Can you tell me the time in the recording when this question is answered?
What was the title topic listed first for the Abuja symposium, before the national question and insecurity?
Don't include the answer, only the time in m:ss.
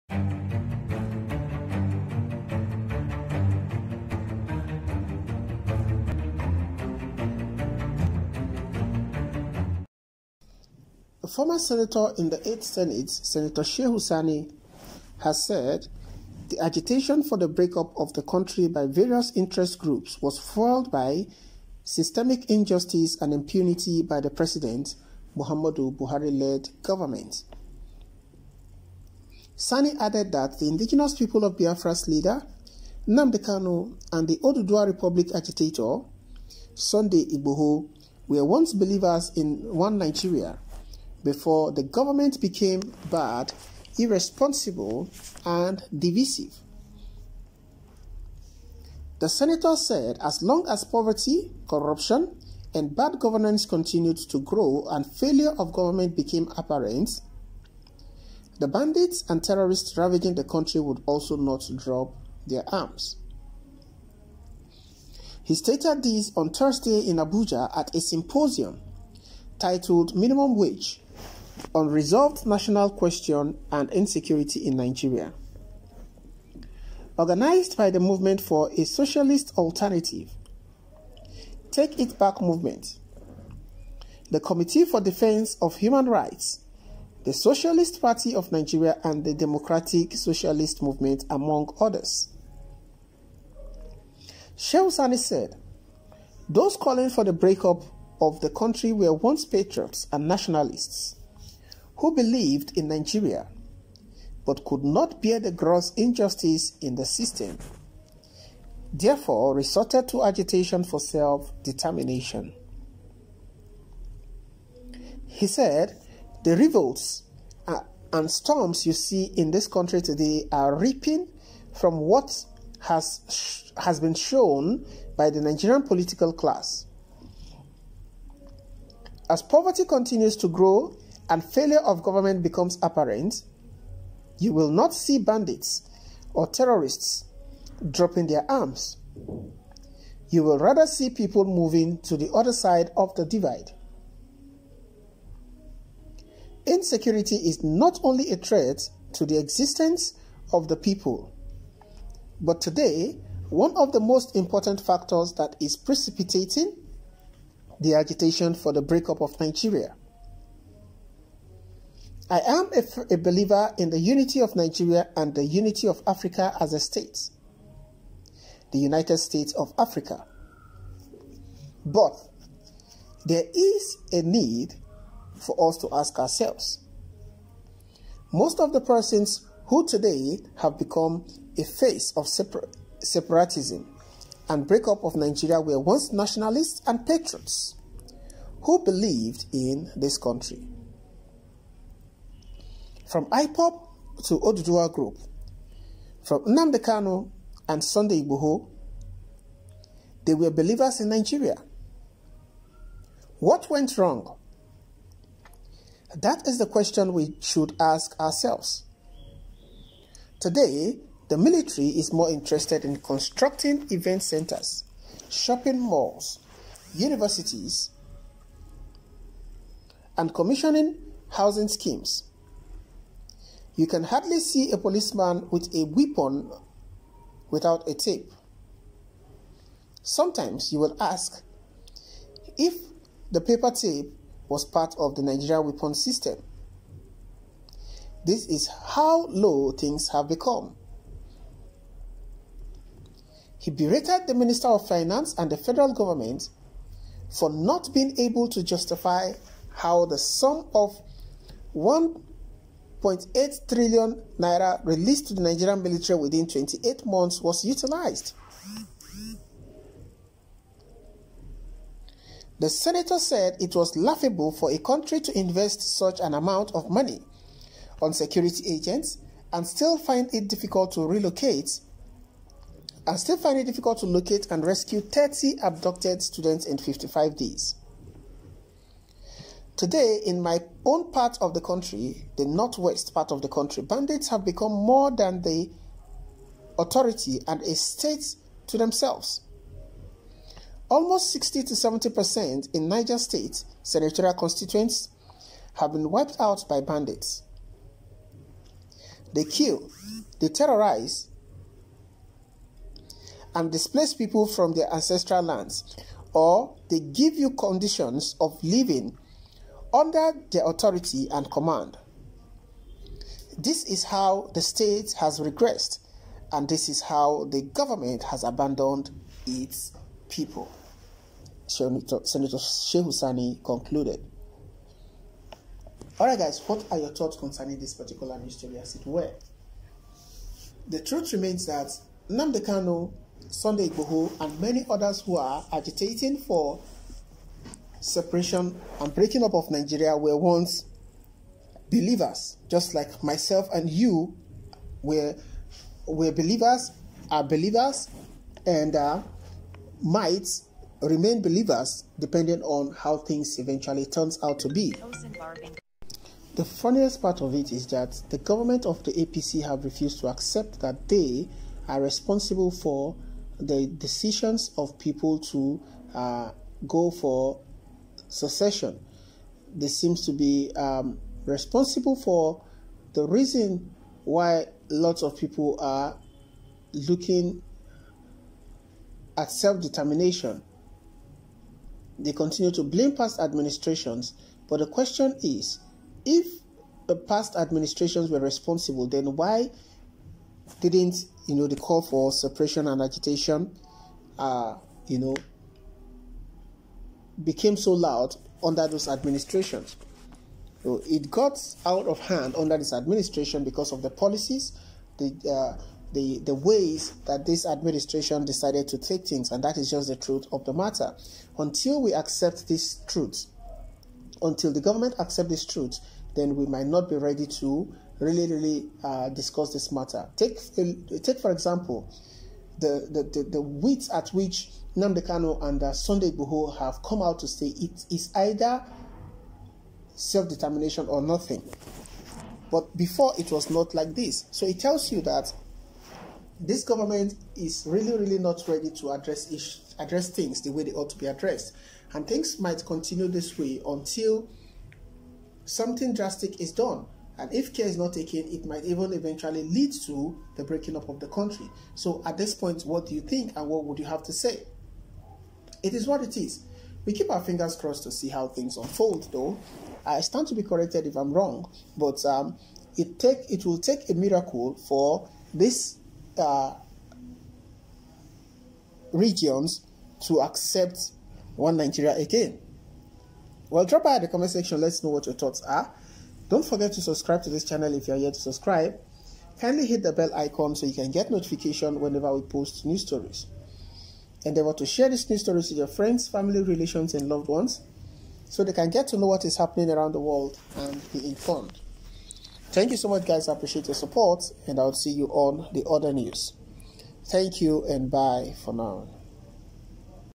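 1:10.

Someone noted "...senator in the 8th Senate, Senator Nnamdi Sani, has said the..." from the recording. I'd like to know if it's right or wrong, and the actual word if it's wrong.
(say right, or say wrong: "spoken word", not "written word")
wrong: "Shehu", not "Nnamdi".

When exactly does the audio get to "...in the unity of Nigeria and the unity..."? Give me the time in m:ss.
2:43.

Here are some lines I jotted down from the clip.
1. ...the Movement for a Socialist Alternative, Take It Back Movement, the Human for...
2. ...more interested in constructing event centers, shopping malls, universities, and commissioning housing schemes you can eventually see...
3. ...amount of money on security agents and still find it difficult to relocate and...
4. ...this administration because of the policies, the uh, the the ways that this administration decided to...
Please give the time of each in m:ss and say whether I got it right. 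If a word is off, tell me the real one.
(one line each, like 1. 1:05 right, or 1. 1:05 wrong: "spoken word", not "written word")
1. 1:17 wrong: "Committee", not "Human"
2. 3:32 wrong: "hardly", not "eventually"
3. 4:26 right
4. 6:42 right.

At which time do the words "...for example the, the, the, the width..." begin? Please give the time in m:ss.
7:01.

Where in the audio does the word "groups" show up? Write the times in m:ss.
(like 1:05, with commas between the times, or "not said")
0:19, 3:14.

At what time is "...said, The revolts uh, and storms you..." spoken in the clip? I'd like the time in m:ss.
1:55.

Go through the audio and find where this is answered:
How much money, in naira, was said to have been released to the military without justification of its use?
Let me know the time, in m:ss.
4:13.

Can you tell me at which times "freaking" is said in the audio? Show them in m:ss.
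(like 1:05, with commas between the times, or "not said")
not said.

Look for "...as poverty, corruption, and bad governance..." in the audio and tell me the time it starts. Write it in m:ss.
0:50.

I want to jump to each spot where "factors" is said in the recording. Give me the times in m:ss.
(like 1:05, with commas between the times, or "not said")
2:34.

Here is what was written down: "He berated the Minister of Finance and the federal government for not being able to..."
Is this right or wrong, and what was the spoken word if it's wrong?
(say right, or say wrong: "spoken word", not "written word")
right.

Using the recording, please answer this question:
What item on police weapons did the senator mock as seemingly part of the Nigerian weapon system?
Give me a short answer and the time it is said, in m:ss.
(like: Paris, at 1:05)
Paper tape, at 3:53.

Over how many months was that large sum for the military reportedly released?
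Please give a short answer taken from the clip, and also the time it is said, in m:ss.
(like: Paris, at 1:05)
28, at 4:16.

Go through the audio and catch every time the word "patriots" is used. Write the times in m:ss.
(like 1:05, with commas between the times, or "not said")
1:39, 3:07.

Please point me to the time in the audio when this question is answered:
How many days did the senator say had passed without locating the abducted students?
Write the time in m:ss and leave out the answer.
4:36.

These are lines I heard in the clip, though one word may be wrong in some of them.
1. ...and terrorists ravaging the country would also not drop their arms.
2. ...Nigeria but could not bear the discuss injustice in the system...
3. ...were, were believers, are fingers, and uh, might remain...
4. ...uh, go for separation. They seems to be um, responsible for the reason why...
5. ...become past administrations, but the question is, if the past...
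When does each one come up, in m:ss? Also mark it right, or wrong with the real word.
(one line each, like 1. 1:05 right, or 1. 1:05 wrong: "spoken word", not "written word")
1. 0:59 right
2. 1:42 wrong: "gross", not "discuss"
3. 5:45 wrong: "believers", not "fingers"
4. 6:06 wrong: "succession", not "separation"
5. 6:22 wrong: "blame", not "become".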